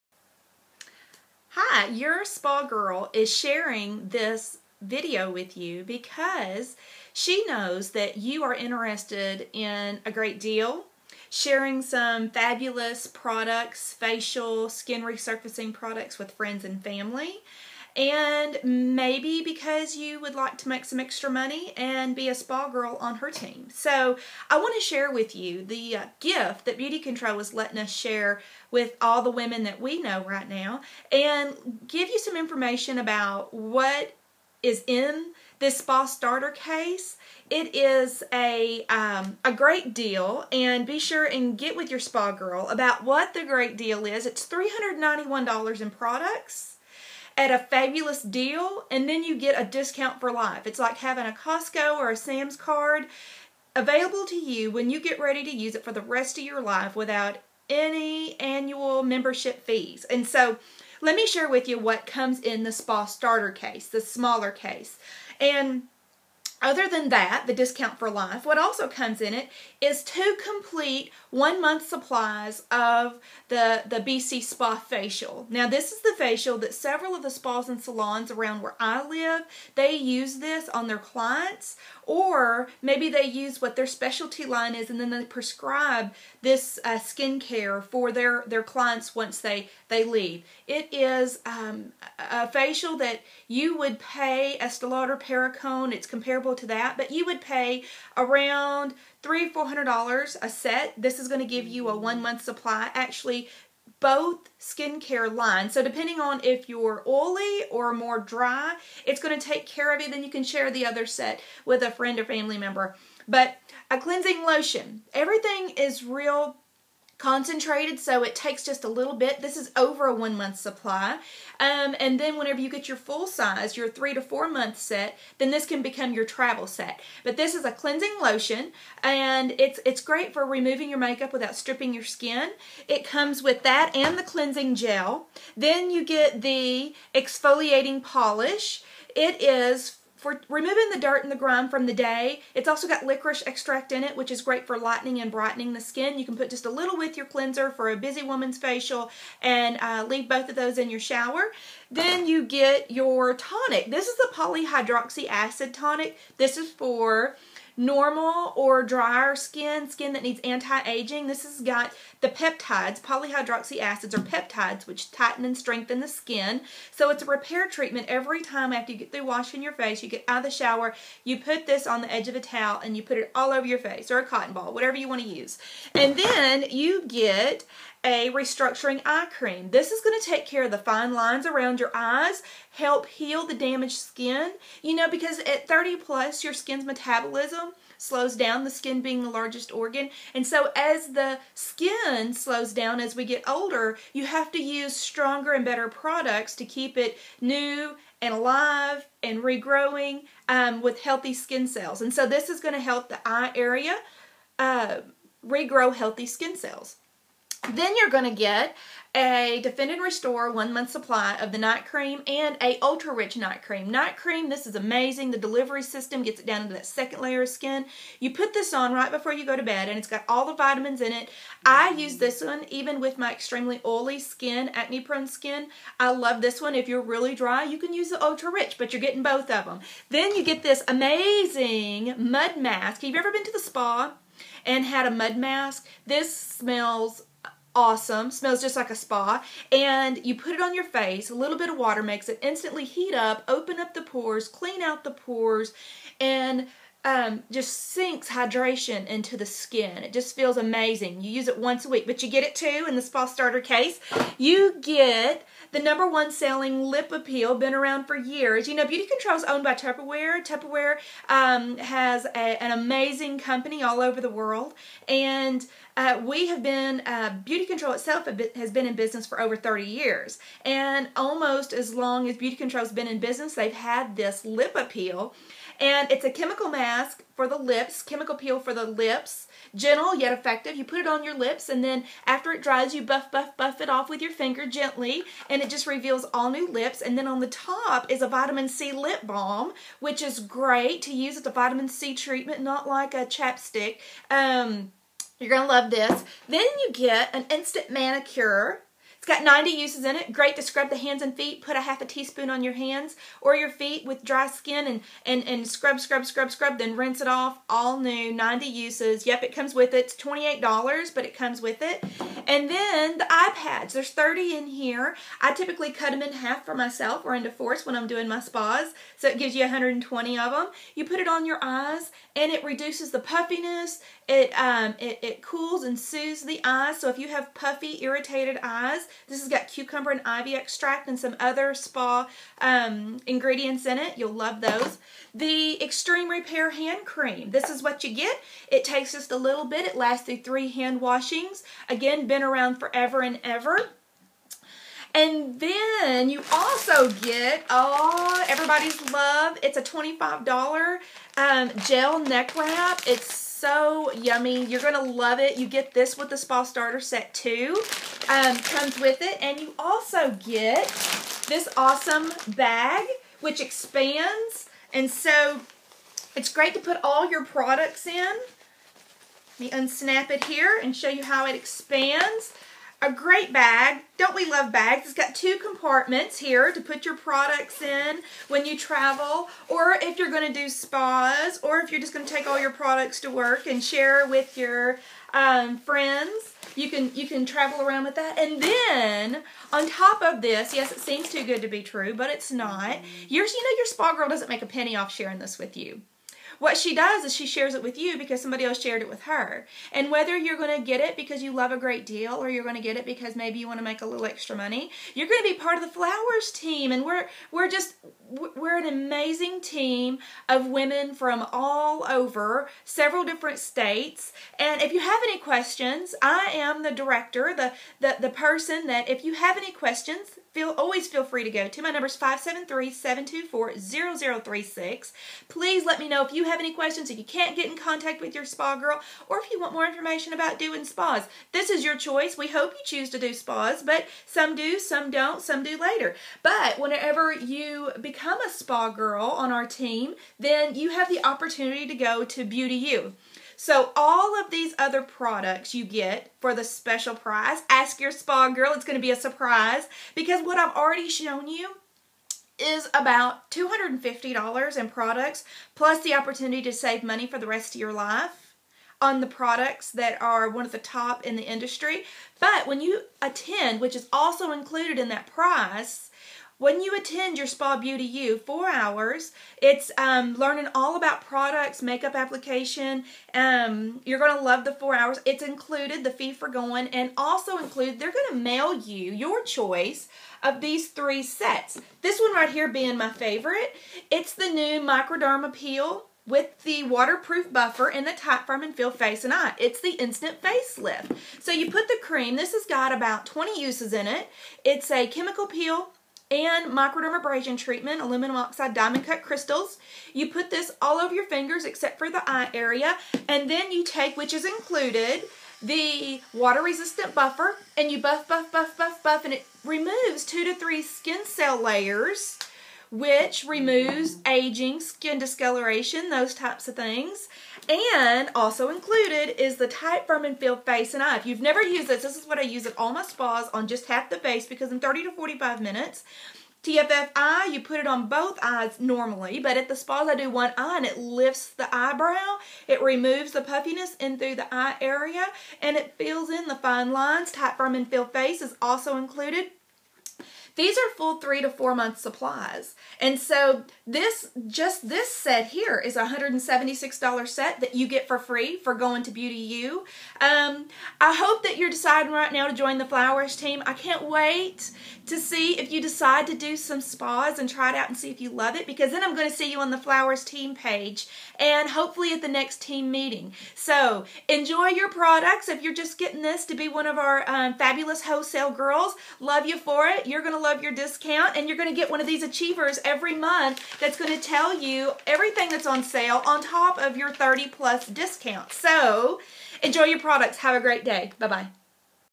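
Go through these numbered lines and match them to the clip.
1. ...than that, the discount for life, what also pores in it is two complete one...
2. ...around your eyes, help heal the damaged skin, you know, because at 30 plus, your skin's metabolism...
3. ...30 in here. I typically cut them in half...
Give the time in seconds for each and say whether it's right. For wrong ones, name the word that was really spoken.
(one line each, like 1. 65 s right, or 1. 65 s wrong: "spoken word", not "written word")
1. 66 s wrong: "comes", not "pores"
2. 181 s right
3. 314 s right.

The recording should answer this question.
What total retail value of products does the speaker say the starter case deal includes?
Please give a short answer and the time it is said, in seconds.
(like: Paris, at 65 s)
$391, at 44 s.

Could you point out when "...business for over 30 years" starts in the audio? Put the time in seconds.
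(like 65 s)
268 s.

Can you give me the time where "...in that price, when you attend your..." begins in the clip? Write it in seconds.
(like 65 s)
464 s.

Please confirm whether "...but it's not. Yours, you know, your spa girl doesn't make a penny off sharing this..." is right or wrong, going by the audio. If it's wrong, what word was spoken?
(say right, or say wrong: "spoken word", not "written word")
right.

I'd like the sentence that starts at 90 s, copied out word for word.
It is um, a facial that you would pay Estee Lauder Perricone.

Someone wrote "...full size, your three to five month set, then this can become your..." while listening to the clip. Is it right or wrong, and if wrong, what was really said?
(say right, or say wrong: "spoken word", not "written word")
wrong: "four", not "five".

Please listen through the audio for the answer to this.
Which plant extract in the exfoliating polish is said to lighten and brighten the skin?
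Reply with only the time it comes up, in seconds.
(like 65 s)
143 s.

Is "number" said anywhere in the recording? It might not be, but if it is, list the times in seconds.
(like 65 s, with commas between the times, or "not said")
255 s, 421 s.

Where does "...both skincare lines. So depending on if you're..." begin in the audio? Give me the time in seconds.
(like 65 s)
103 s.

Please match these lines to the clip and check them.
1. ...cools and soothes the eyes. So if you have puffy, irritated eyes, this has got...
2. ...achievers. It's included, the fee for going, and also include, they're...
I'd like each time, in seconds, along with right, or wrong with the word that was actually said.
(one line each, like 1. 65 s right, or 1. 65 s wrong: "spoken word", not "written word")
1. 325 s right
2. 474 s wrong: "hours", not "achievers".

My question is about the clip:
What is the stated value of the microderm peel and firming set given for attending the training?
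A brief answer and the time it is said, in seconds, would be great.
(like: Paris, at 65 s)
$176, at 546 s.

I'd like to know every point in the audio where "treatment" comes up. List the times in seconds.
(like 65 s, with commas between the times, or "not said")
167 s, 292 s, 497 s.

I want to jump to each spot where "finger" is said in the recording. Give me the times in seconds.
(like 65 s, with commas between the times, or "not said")
284 s, 501 s.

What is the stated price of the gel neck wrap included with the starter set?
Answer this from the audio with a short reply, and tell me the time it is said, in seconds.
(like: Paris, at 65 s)
$25, at 349 s.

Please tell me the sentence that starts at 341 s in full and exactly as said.
Again, been around forever and ever.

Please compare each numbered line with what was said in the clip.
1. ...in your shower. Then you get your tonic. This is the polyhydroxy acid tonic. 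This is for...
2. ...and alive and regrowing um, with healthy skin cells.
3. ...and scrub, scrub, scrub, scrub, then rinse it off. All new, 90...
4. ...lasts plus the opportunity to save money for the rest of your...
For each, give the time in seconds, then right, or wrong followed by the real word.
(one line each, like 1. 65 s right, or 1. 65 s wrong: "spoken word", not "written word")
1. 150 s right
2. 198 s right
3. 305 s right
4. 454 s wrong: "products", not "lasts".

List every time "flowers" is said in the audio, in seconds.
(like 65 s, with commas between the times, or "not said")
405 s, 552 s, 559 s.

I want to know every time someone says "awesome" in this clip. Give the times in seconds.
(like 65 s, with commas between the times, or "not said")
237 s, 361 s.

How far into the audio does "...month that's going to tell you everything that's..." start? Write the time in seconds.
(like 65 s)
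573 s.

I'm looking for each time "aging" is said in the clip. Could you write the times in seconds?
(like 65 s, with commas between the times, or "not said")
160 s, 514 s.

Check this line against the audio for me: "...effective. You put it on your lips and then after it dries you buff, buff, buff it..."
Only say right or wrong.
right.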